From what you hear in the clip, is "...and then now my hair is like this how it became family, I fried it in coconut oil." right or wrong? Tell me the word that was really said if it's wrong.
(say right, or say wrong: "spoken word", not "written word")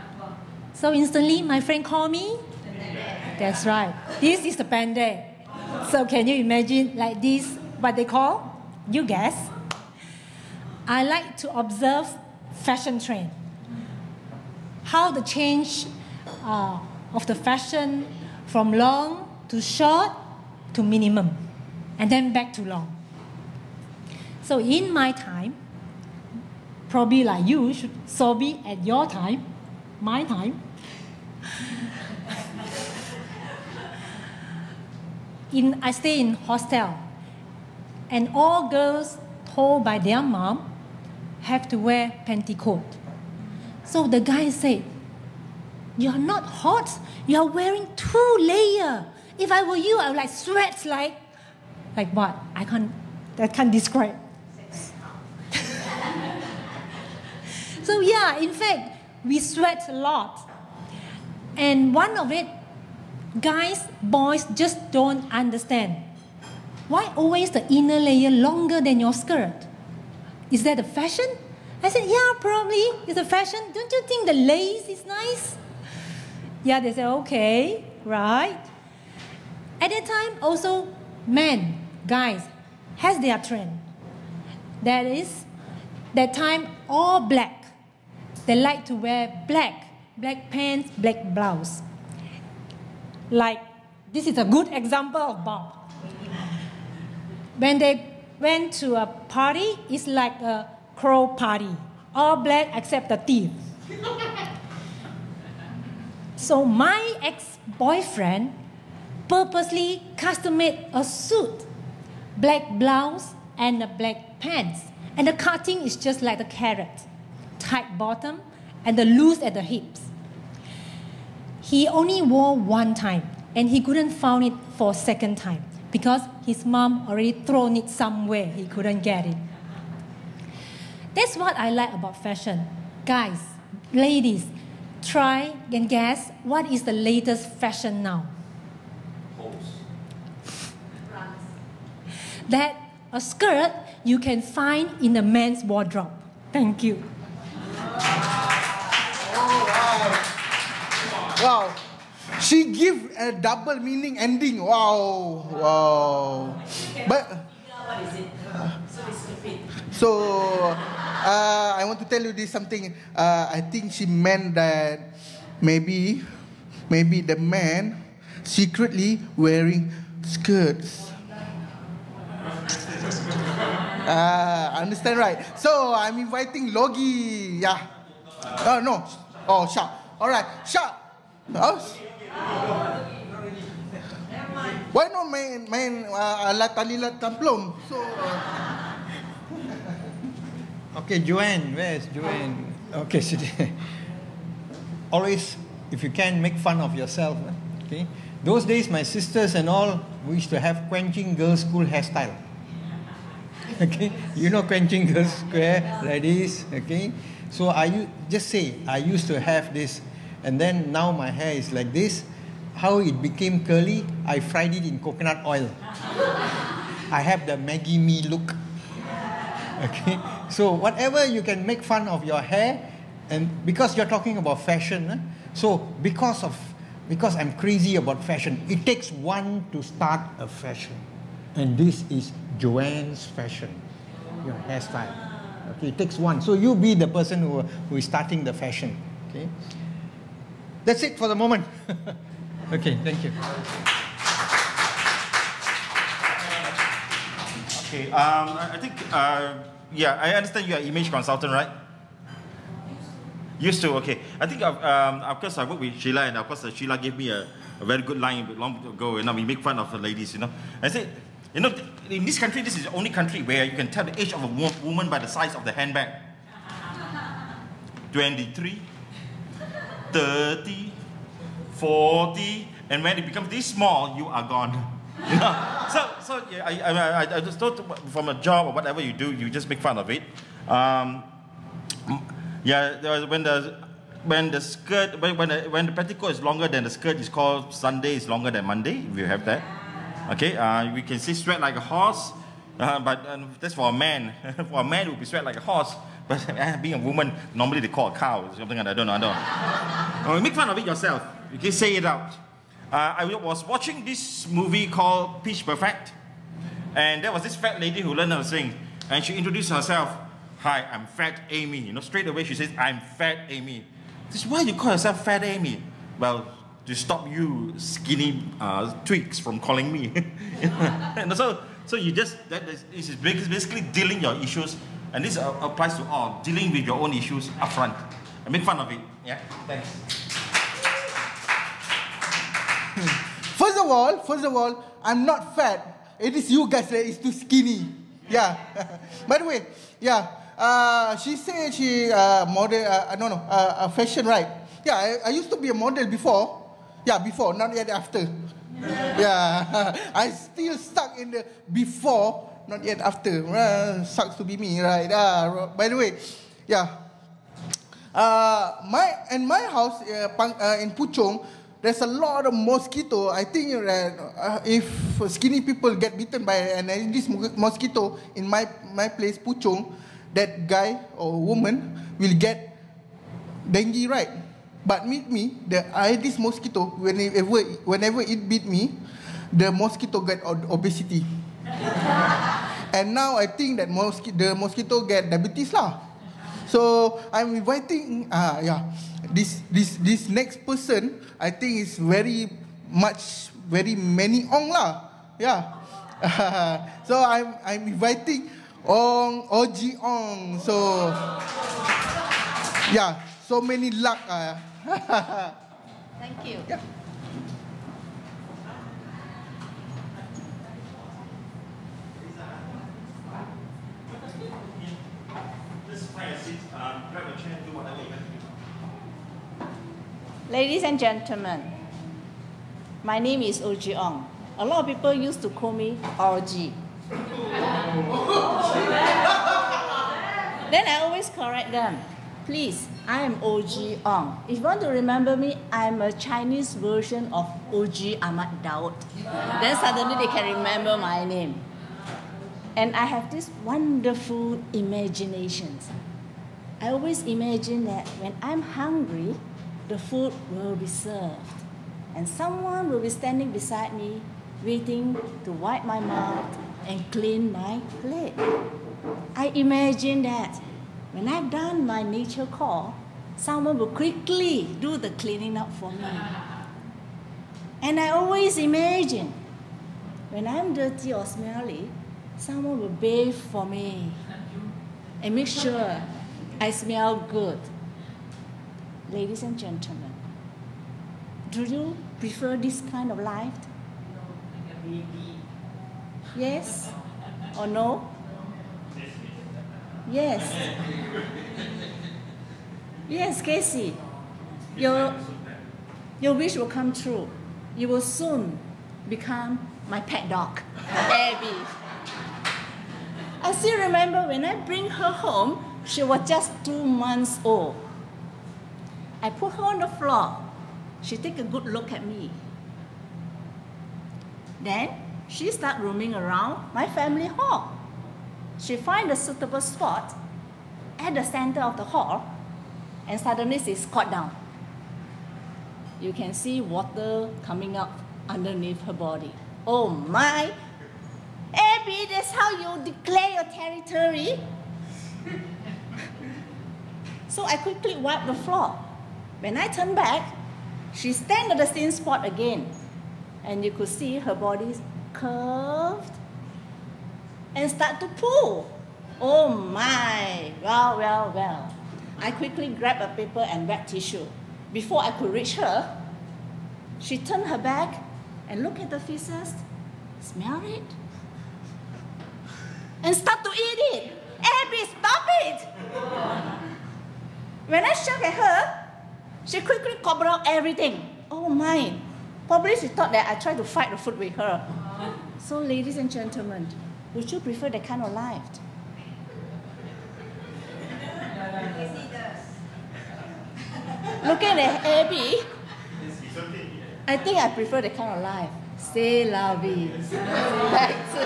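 wrong: "curly", not "family".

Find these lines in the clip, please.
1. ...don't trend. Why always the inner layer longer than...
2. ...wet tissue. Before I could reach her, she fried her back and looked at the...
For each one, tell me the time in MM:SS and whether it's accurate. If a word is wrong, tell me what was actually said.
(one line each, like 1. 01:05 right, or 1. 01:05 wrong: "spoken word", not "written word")
1. 01:04 wrong: "understand", not "trend"
2. 09:13 wrong: "turned", not "fried".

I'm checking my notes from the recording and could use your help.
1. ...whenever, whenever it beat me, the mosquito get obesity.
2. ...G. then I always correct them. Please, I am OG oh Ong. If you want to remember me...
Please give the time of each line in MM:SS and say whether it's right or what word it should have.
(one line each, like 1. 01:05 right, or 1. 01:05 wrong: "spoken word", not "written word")
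1. 06:16 right
2. 07:06 right.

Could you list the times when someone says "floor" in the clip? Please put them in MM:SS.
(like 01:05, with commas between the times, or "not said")
08:29, 08:58.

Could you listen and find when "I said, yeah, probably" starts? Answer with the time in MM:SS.
01:11.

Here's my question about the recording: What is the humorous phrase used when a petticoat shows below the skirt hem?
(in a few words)
Sunday is longer than Monday.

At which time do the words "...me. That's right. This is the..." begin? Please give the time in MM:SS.
00:02.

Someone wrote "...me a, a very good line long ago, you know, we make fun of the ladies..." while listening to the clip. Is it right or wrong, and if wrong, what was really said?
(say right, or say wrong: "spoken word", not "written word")
right.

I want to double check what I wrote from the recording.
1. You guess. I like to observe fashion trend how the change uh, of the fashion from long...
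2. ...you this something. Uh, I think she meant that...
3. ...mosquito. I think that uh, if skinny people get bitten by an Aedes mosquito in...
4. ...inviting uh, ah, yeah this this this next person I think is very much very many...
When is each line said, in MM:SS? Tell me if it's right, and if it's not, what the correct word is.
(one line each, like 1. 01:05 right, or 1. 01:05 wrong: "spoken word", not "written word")
1. 00:08 right
2. 02:42 right
3. 06:02 right
4. 06:27 right.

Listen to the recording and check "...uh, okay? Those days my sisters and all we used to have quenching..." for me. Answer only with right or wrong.
right.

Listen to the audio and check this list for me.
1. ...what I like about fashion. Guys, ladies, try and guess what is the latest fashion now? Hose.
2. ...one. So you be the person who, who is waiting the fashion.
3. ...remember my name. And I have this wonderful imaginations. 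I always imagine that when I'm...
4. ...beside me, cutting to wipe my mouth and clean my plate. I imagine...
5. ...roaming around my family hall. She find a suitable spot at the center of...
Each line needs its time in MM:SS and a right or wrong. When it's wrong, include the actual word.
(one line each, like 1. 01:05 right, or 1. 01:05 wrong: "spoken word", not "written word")
1. 02:11 right
2. 03:56 wrong: "starting", not "waiting"
3. 07:20 right
4. 07:33 wrong: "waiting", not "cutting"
5. 08:35 right.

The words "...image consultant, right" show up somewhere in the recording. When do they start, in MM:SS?
04:10.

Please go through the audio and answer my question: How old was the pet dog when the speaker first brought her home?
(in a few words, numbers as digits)
2 months.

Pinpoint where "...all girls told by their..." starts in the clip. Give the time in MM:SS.
00:38.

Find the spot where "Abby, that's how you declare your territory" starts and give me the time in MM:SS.
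08:51.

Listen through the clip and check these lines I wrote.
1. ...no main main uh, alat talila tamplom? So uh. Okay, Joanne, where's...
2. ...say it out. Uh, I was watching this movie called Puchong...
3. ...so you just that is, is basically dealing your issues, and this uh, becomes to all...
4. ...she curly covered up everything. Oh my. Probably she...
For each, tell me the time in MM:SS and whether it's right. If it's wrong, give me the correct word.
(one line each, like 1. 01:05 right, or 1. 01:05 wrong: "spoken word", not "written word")
1. 03:05 right
2. 05:01 wrong: "Pitch", not "Puchong"
3. 05:21 wrong: "applies", not "becomes"
4. 09:29 wrong: "quickly", not "curly".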